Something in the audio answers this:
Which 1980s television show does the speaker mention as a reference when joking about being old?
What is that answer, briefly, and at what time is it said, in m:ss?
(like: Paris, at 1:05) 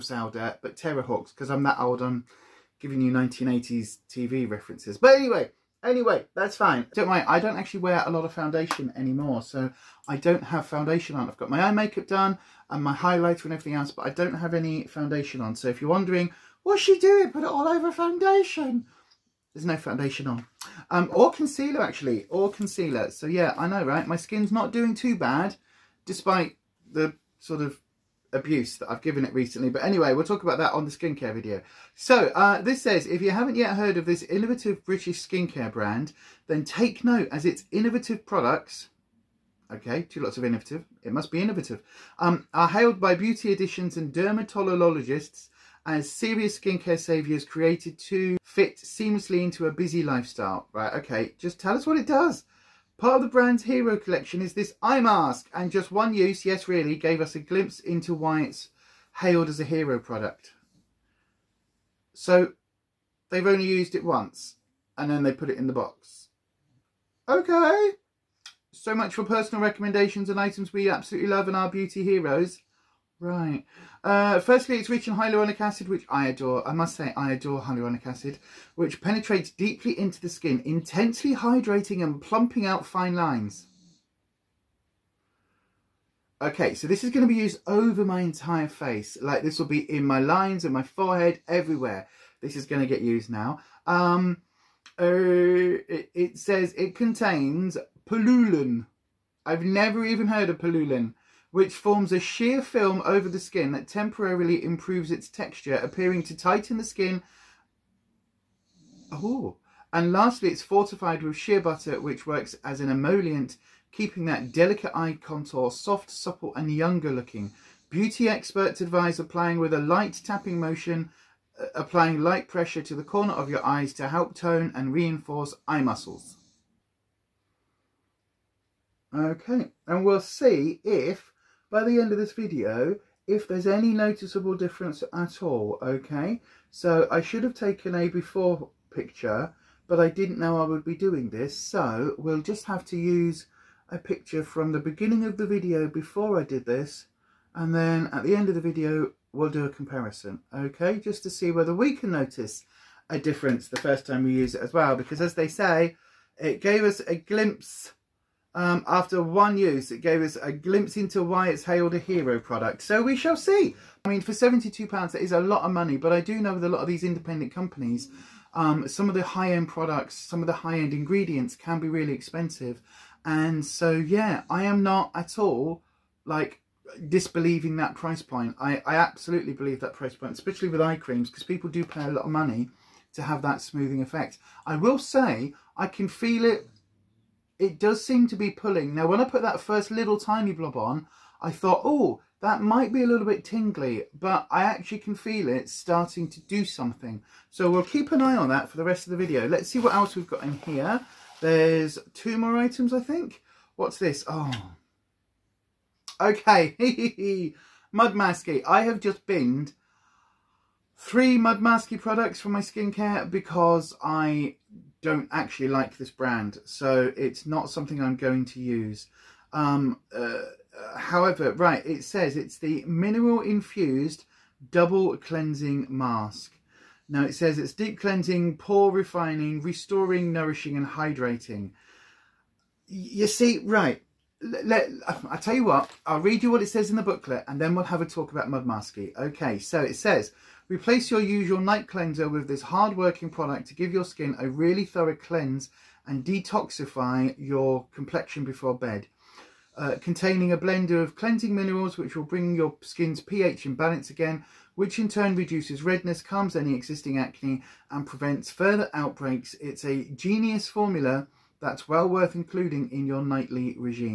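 Terrahawks, at 0:00.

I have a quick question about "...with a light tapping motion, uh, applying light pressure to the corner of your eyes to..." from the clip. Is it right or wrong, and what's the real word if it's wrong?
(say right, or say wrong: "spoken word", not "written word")
right.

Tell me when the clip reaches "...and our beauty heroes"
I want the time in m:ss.
1:11.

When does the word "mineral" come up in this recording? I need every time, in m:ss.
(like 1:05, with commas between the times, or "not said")
3:42, 4:11.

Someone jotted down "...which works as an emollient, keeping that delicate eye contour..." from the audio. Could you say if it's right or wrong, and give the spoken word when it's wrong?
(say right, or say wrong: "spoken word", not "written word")
right.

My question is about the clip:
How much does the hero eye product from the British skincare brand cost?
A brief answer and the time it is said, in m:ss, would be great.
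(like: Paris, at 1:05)
£72, at 2:44.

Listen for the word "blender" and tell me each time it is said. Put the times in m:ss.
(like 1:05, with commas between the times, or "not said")
4:10.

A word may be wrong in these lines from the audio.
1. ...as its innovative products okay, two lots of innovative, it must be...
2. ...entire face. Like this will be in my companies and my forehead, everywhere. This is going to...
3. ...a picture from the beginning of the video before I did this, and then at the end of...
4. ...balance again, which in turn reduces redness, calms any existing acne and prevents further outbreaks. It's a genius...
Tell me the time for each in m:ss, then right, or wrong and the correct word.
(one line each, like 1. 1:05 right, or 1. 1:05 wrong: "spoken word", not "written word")
1. 0:37 right
2. 1:28 wrong: "lines", not "companies"
3. 2:23 right
4. 4:13 right.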